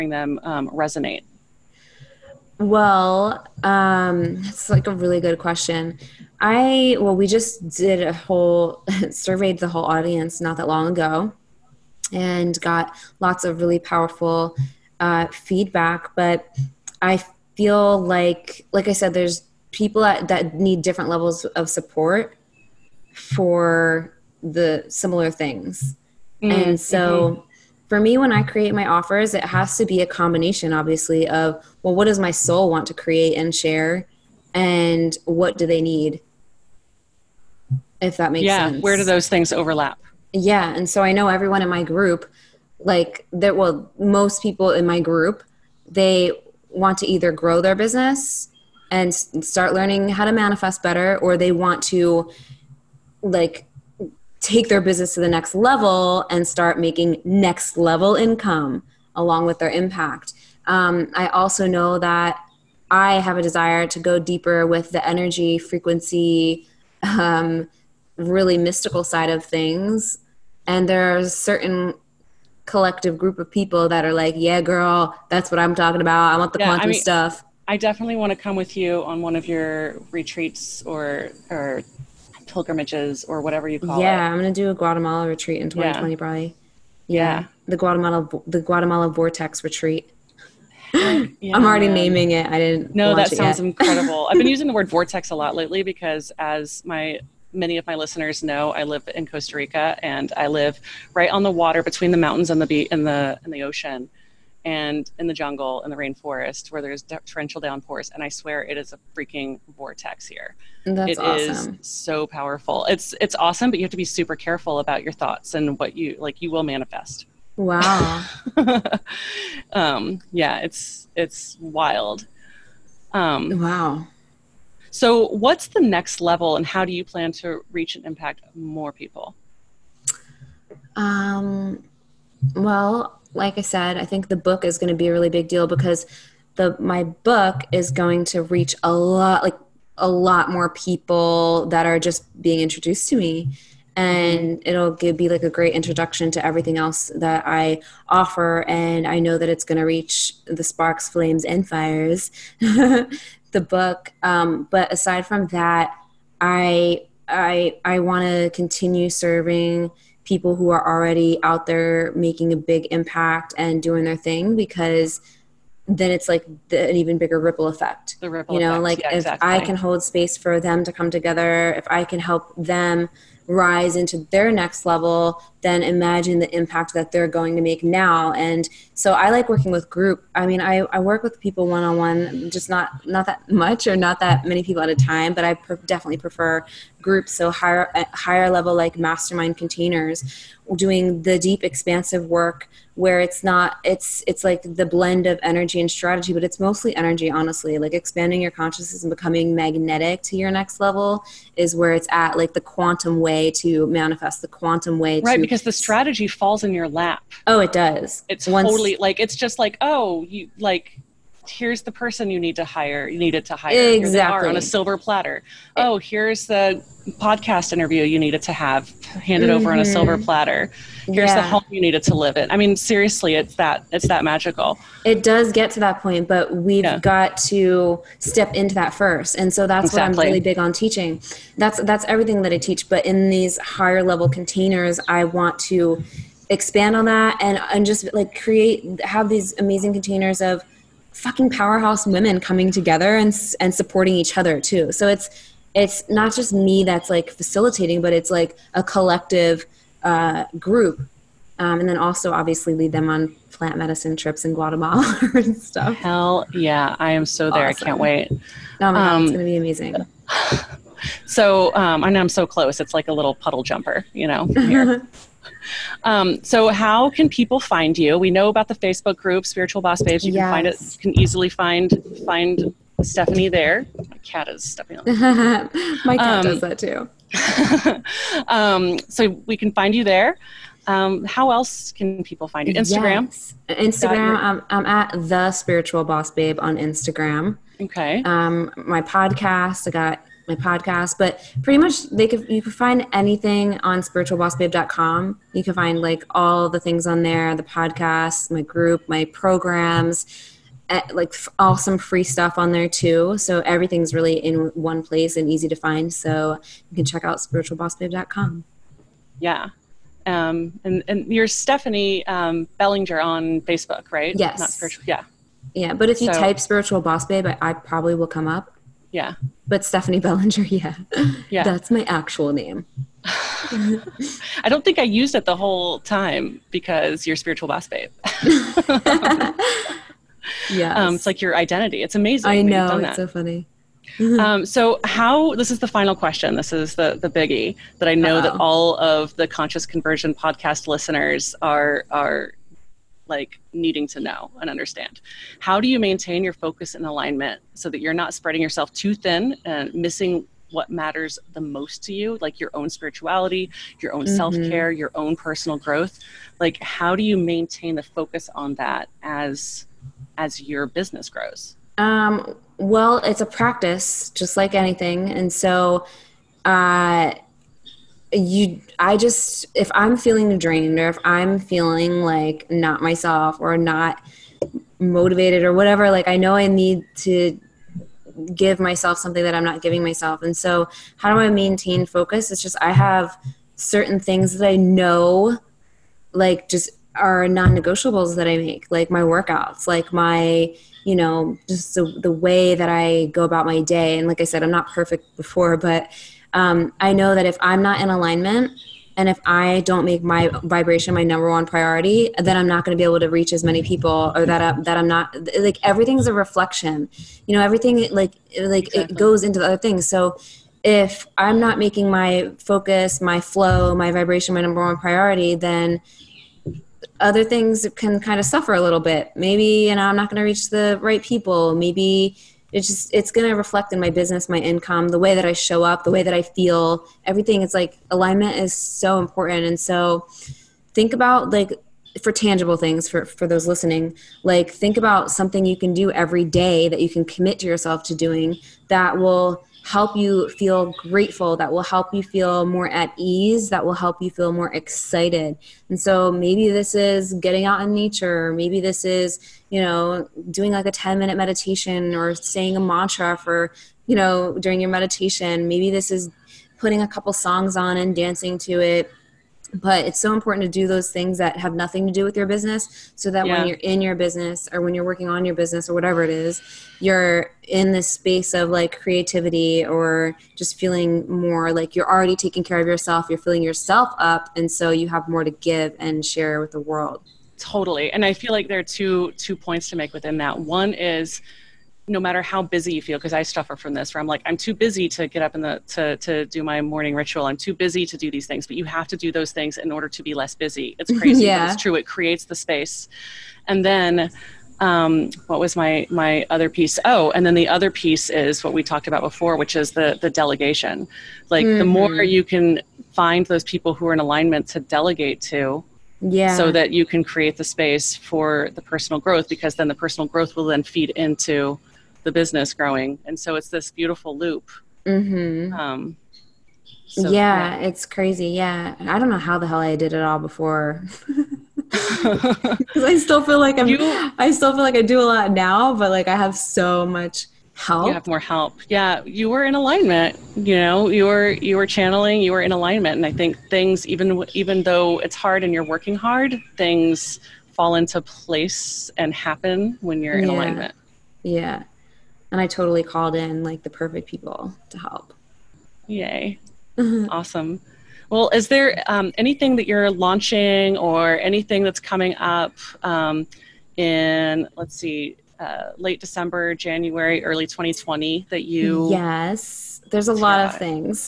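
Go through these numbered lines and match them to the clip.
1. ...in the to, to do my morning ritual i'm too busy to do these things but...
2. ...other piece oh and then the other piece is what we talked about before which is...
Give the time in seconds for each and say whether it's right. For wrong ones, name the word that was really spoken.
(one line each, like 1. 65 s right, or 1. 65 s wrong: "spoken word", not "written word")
1. 485 s right
2. 496 s right.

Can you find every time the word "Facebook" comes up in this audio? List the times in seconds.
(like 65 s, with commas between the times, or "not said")
268 s, 313 s.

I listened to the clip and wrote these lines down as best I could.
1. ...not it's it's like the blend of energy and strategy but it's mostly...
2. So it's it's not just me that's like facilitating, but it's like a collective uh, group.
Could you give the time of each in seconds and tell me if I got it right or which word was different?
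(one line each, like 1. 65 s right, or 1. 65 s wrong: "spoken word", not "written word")
1. 193 s right
2. 244 s right.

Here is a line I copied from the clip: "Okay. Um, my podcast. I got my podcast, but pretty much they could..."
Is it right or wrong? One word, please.
right.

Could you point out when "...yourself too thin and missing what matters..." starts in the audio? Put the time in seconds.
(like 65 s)
348 s.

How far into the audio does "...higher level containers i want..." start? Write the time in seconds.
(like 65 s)
233 s.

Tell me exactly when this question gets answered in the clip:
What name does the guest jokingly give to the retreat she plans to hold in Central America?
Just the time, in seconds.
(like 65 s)
88 s.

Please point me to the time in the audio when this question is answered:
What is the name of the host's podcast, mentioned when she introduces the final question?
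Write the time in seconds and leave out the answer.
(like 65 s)
339 s.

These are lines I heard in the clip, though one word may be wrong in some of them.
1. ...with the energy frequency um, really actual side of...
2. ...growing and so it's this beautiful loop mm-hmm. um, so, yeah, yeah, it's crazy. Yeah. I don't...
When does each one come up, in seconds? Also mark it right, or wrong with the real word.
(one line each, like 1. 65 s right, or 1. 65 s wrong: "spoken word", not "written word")
1. 64 s wrong: "mystical", not "actual"
2. 512 s right.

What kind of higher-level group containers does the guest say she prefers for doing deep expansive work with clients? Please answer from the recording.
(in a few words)
mastermind containers.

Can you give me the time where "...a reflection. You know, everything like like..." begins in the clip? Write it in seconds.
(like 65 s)
406 s.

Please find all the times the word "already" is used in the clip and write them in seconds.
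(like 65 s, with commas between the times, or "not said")
91 s, 160 s, 472 s.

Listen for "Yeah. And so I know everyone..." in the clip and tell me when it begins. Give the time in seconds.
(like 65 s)
40 s.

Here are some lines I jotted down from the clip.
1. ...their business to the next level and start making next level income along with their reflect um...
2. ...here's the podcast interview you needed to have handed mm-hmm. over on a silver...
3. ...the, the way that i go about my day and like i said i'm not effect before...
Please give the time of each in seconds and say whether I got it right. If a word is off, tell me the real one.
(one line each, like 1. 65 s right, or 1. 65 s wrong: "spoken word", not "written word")
1. 54 s wrong: "impact", not "reflect"
2. 215 s right
3. 391 s wrong: "perfect", not "effect".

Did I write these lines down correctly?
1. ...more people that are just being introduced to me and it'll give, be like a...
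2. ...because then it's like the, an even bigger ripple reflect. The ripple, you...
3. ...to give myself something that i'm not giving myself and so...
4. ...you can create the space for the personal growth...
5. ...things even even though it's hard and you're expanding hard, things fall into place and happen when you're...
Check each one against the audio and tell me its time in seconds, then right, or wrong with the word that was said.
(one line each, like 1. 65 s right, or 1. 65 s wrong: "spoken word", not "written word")
1. 140 s right
2. 164 s wrong: "effect", not "reflect"
3. 377 s right
4. 506 s right
5. 533 s wrong: "working", not "expanding".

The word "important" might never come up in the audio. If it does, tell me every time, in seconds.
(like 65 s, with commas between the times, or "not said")
429 s, 460 s.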